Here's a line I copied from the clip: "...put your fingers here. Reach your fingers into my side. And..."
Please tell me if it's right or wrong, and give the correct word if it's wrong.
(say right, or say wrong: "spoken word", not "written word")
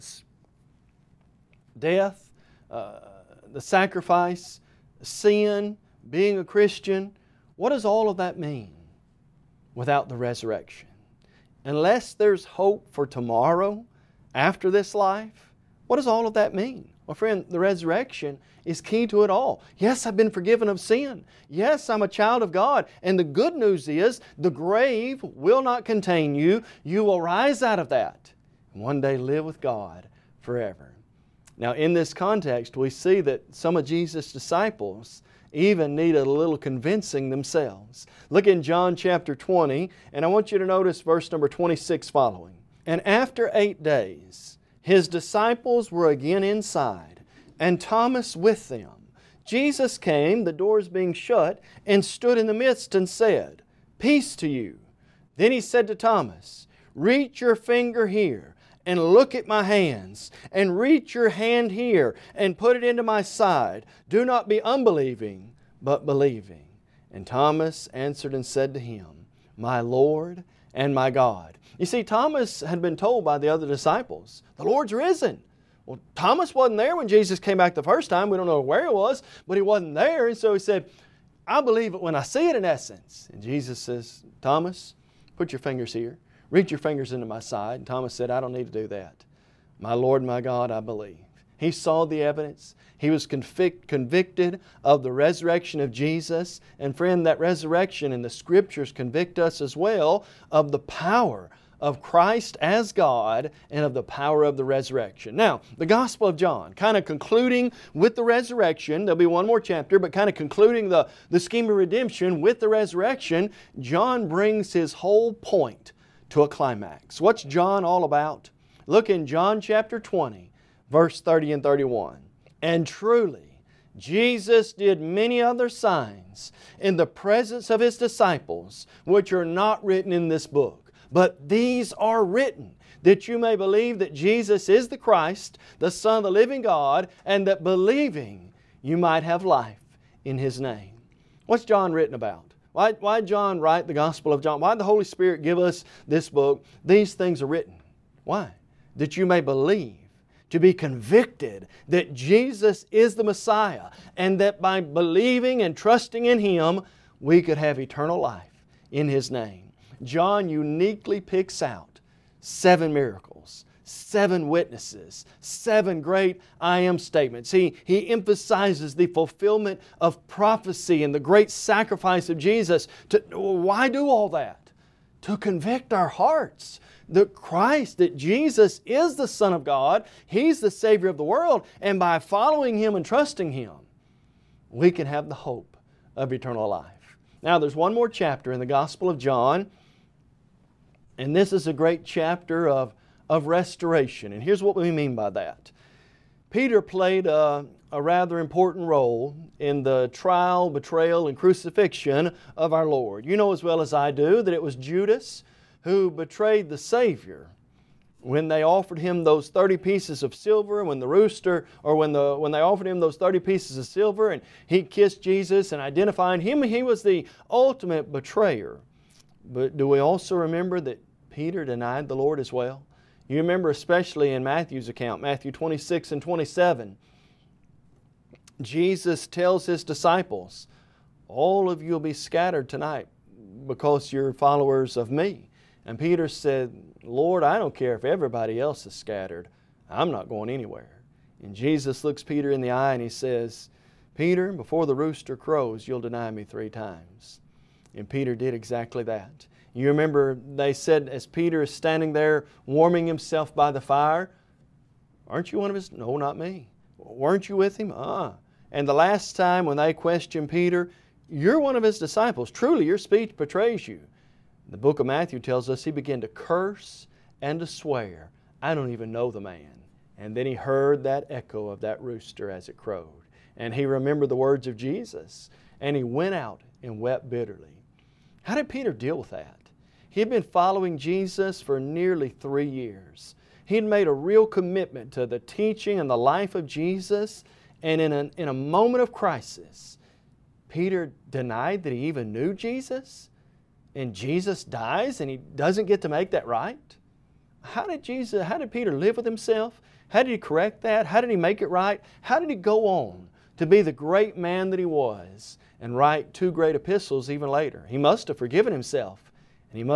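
right.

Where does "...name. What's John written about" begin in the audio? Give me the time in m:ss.
2:20.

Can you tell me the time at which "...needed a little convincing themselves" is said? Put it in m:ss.
0:35.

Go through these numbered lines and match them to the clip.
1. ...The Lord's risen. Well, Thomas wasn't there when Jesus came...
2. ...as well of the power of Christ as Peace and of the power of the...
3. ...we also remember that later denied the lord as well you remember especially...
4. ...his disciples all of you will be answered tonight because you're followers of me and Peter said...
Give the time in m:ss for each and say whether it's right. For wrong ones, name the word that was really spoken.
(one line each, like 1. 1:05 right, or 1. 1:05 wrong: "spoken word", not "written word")
1. 1:14 right
2. 1:39 wrong: "God", not "Peace"
3. 3:39 wrong: "peter", not "later"
4. 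3:49 wrong: "scattered", not "answered".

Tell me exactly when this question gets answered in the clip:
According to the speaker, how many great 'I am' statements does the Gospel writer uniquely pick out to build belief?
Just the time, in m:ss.
2:45.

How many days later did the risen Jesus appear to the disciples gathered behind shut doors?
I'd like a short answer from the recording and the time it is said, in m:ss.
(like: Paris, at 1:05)
8, at 0:43.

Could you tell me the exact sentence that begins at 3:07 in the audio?
Now, there's one more chapter in the Gospel of John, and this is a great chapter of, of restoration.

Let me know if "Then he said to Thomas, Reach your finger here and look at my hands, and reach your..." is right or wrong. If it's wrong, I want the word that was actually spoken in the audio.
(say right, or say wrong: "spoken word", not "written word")
right.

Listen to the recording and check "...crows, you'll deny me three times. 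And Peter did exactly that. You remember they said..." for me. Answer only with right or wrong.
right.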